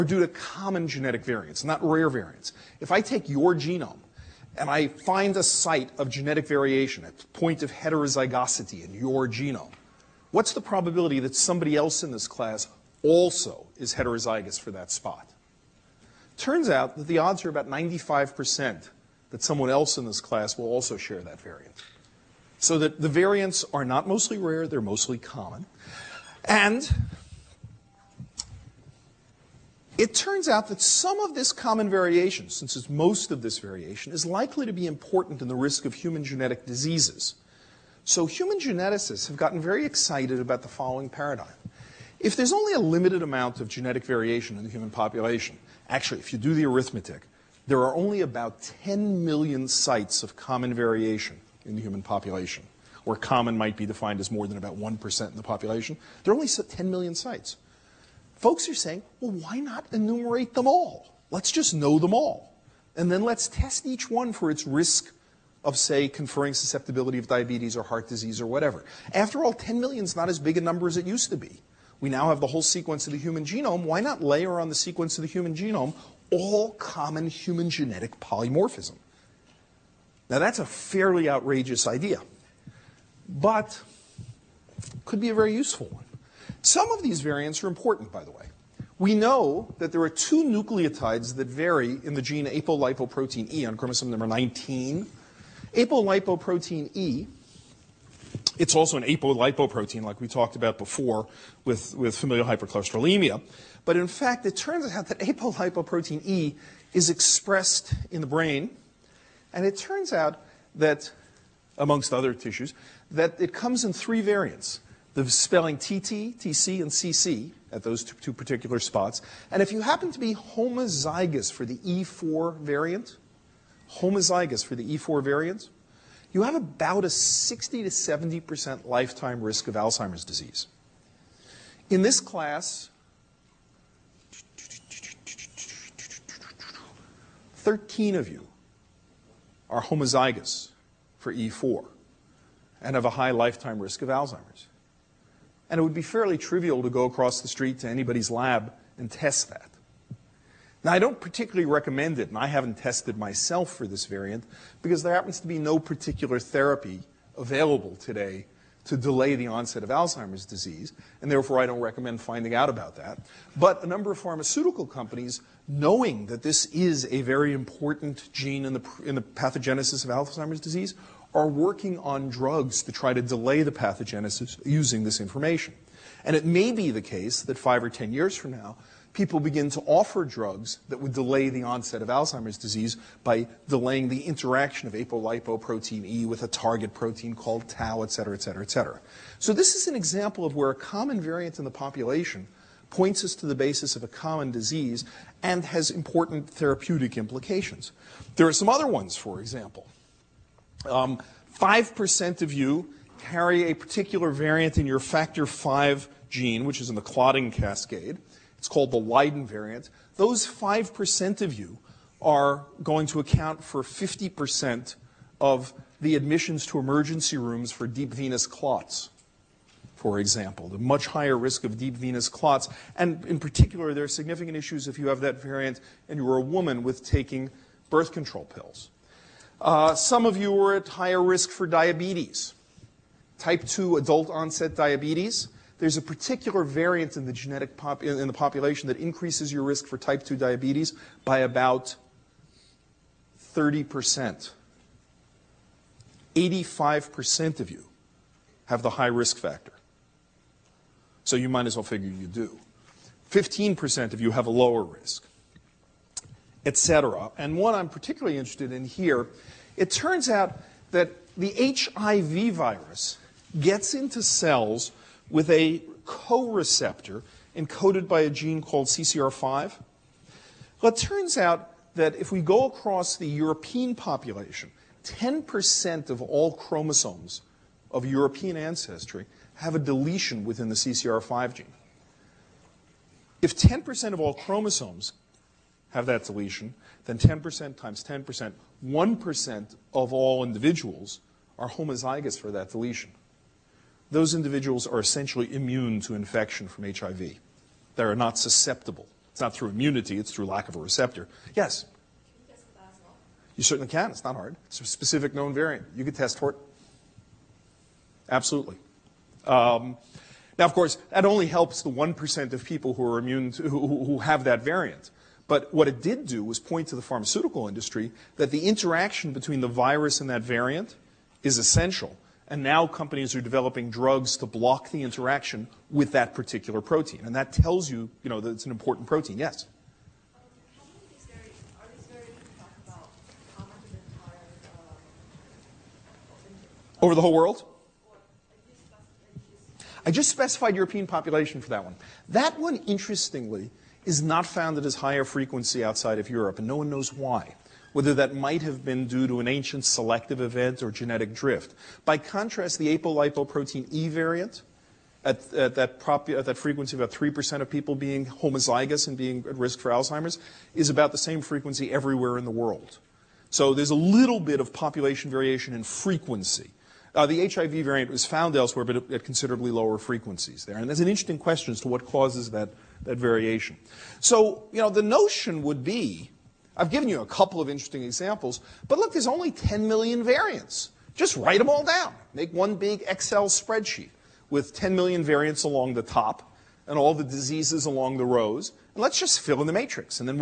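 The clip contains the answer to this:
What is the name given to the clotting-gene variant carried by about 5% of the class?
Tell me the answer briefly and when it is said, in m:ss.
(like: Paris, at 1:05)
Leiden variant, at 3:28.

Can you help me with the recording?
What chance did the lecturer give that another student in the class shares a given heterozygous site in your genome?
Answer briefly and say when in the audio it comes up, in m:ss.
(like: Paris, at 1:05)
95%, at 0:17.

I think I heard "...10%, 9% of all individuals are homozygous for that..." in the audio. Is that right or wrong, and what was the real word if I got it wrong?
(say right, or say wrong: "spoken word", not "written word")
wrong: "1", not "9".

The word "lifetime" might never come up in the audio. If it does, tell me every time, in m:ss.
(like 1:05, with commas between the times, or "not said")
2:08, 2:23.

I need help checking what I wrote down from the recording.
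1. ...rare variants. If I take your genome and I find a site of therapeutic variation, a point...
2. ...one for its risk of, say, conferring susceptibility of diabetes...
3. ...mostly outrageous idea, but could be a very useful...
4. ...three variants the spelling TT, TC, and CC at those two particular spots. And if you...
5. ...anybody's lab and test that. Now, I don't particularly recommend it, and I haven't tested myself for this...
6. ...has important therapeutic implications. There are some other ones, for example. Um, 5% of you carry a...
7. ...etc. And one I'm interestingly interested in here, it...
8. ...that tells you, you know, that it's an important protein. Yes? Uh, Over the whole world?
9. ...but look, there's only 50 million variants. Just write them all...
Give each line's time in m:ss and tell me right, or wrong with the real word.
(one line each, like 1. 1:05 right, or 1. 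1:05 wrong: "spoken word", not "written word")
1. 0:01 wrong: "genetic", not "therapeutic"
2. 1:04 right
3. 1:20 wrong: "fairly", not "mostly"
4. 1:53 right
5. 2:27 right
6. 3:15 right
7. 4:16 wrong: "particularly", not "interestingly"
8. 5:27 right
9. 6:18 wrong: "10", not "50".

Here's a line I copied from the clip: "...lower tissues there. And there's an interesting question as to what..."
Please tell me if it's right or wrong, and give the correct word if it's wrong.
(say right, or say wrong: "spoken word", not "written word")
wrong: "frequencies", not "tissues".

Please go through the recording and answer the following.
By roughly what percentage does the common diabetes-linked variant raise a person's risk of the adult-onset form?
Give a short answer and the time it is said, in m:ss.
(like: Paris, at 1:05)
30%, at 4:03.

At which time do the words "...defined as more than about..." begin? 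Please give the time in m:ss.
0:53.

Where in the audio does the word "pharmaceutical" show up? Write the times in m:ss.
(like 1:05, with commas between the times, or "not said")
2:44, 5:17.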